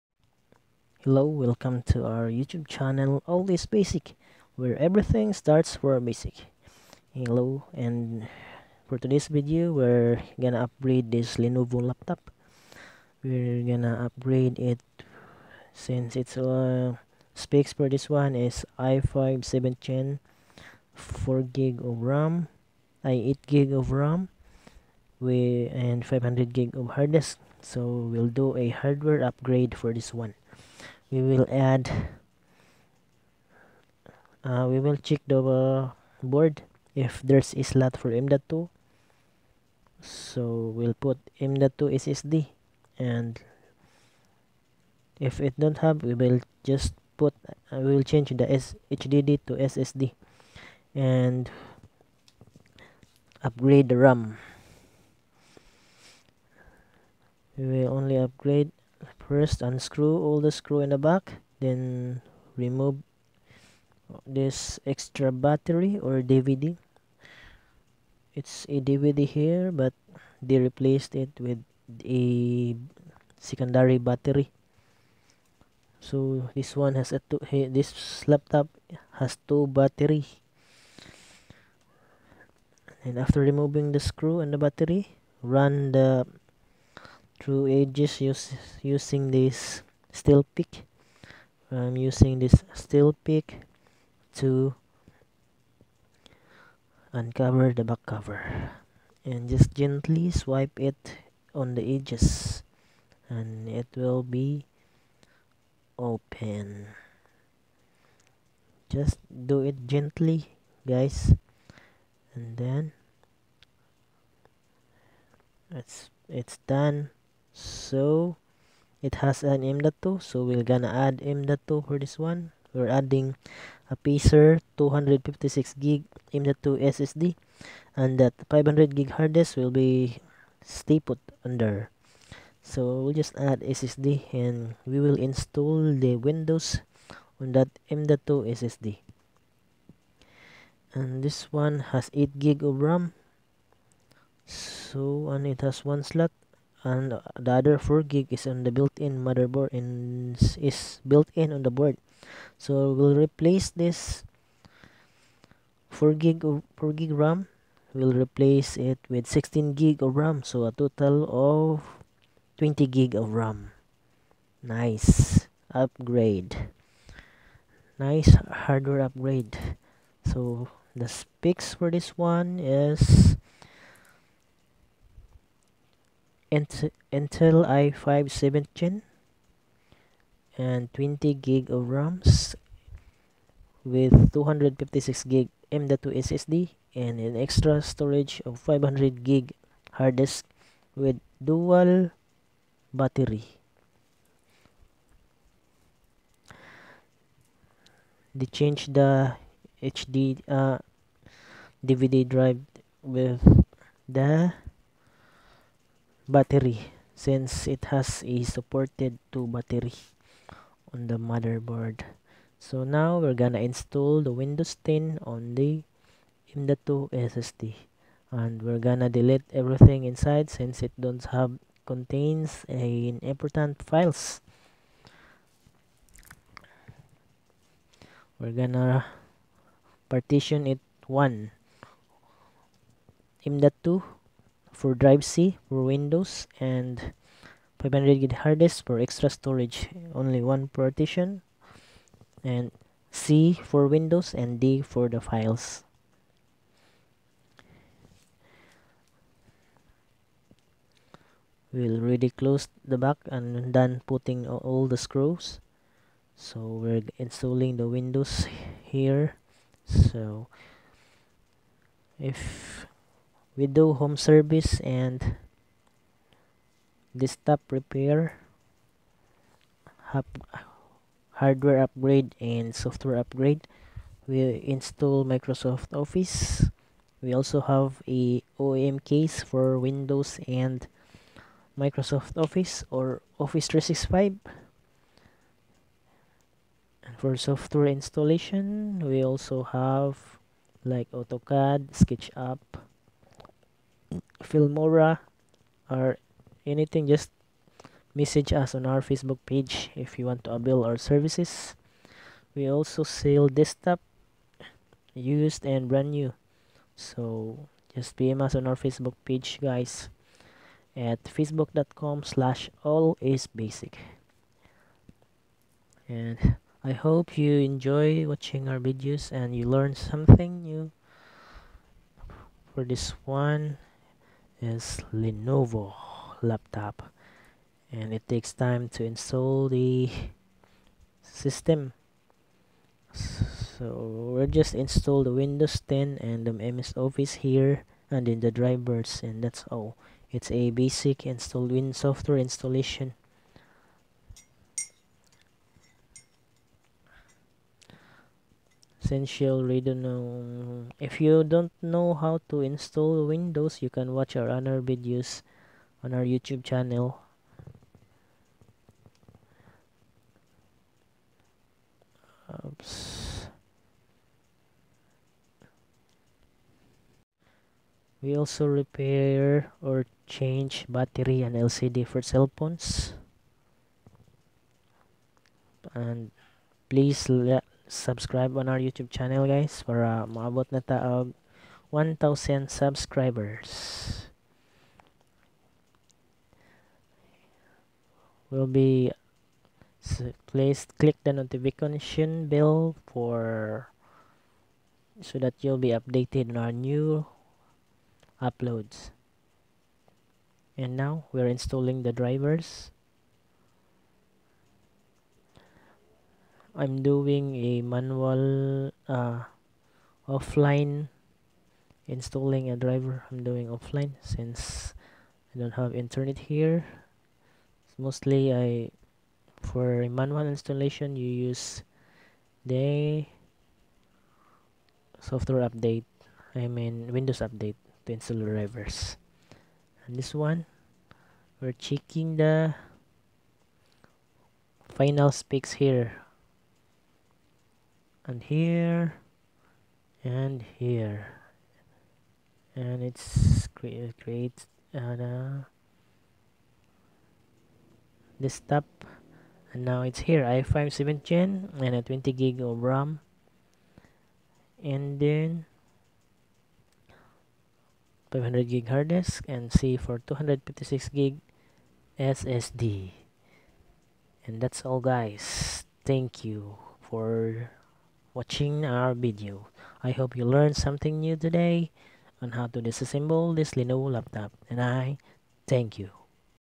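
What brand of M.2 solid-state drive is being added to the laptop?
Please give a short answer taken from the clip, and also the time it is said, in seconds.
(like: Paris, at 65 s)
Apacer, at 123 s.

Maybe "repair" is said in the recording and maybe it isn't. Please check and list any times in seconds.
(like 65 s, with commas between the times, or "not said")
267 s, 368 s.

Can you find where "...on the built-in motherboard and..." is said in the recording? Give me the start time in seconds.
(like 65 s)
148 s.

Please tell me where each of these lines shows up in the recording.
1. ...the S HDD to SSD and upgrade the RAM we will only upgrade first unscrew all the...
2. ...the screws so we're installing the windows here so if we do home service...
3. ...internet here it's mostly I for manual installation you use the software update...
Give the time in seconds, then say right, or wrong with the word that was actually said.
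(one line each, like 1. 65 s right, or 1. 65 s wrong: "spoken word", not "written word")
1. 48 s right
2. 254 s right
3. 415 s right.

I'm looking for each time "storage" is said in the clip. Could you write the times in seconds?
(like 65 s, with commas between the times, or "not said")
187 s, 239 s.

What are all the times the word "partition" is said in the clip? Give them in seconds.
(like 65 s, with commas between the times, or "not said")
230 s, 240 s.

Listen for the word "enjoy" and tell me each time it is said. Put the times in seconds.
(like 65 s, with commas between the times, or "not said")
317 s.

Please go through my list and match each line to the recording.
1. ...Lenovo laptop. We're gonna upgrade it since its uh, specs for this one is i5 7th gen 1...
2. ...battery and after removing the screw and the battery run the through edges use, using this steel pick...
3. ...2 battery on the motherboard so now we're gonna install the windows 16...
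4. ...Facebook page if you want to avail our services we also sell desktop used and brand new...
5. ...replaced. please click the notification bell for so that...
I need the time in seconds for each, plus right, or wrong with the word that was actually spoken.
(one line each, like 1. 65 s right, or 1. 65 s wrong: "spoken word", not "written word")
1. 11 s wrong: "4", not "1"
2. 79 s right
3. 209 s wrong: "10", not "16"
4. 299 s right
5. 389 s wrong: "placed", not "replaced".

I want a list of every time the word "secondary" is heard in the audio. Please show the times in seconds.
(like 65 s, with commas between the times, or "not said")
73 s.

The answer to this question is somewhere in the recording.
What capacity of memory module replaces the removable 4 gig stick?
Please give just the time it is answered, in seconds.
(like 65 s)
159 s.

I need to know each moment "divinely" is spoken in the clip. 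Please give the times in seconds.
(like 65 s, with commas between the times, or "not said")
not said.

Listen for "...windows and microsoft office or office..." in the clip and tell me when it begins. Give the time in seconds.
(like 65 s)
279 s.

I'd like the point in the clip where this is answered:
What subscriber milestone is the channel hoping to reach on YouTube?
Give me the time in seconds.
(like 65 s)
380 s.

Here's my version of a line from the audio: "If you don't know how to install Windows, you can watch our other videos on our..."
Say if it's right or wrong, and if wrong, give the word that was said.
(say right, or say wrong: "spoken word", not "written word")
right.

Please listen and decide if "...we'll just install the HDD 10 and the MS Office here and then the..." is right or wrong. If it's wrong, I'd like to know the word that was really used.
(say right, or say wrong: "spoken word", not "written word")
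wrong: "Windows", not "HDD".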